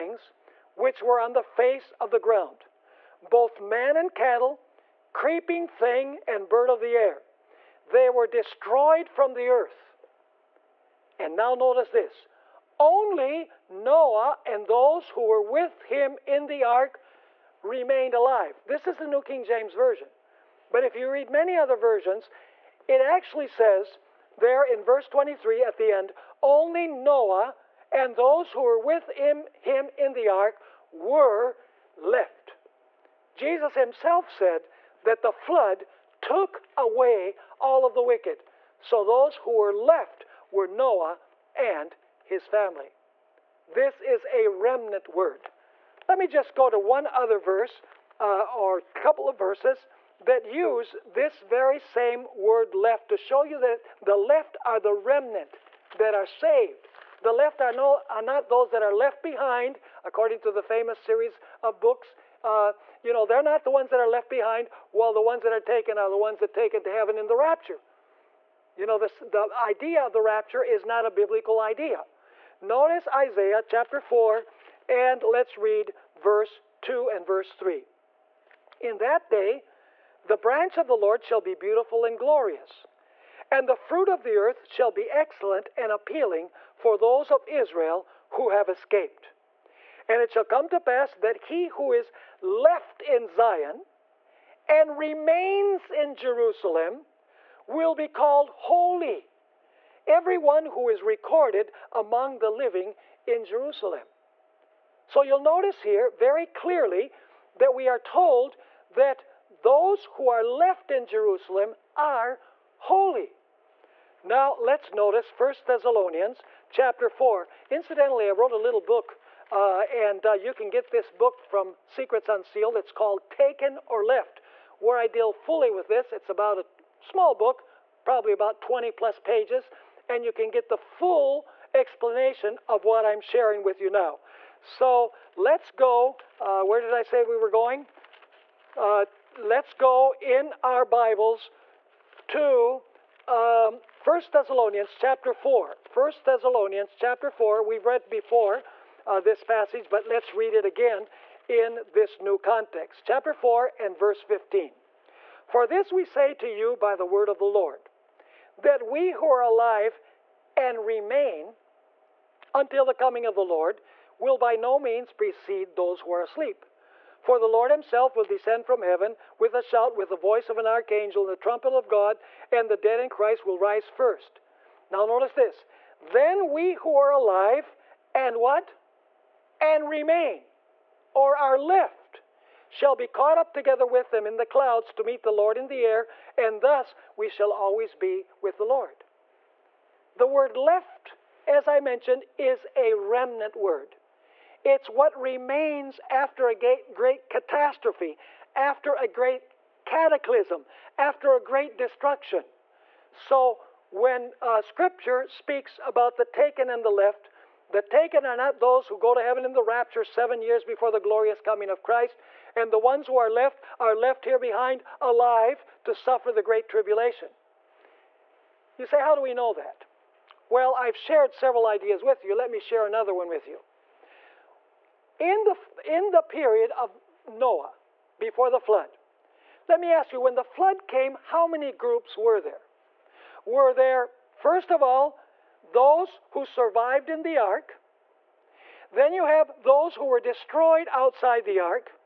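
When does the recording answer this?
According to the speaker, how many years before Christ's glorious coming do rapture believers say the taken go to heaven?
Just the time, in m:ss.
3:30.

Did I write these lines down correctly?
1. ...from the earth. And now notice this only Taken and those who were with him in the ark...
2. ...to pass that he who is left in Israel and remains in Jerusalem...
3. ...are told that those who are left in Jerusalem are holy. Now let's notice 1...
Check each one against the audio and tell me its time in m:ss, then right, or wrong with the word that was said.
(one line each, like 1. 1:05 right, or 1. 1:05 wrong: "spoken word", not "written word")
1. 0:09 wrong: "Noah", not "Taken"
2. 1:30 wrong: "Zion", not "Israel"
3. 1:47 right.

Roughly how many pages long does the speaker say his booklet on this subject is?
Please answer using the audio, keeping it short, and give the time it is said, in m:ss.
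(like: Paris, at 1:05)
20 plus pages, at 2:08.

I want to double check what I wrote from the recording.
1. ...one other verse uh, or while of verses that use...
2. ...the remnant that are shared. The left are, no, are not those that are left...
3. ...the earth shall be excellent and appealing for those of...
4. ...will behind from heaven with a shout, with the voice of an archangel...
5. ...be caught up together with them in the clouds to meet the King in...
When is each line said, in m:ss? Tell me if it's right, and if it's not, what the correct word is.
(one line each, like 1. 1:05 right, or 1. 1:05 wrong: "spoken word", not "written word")
1. 0:46 wrong: "couple", not "while"
2. 0:54 wrong: "saved", not "shared"
3. 1:24 right
4. 2:48 wrong: "descend", not "behind"
5. 3:02 wrong: "Lord", not "King".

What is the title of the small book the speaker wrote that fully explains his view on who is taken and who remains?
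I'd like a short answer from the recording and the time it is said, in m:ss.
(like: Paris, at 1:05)
Taken or Left, at 2:03.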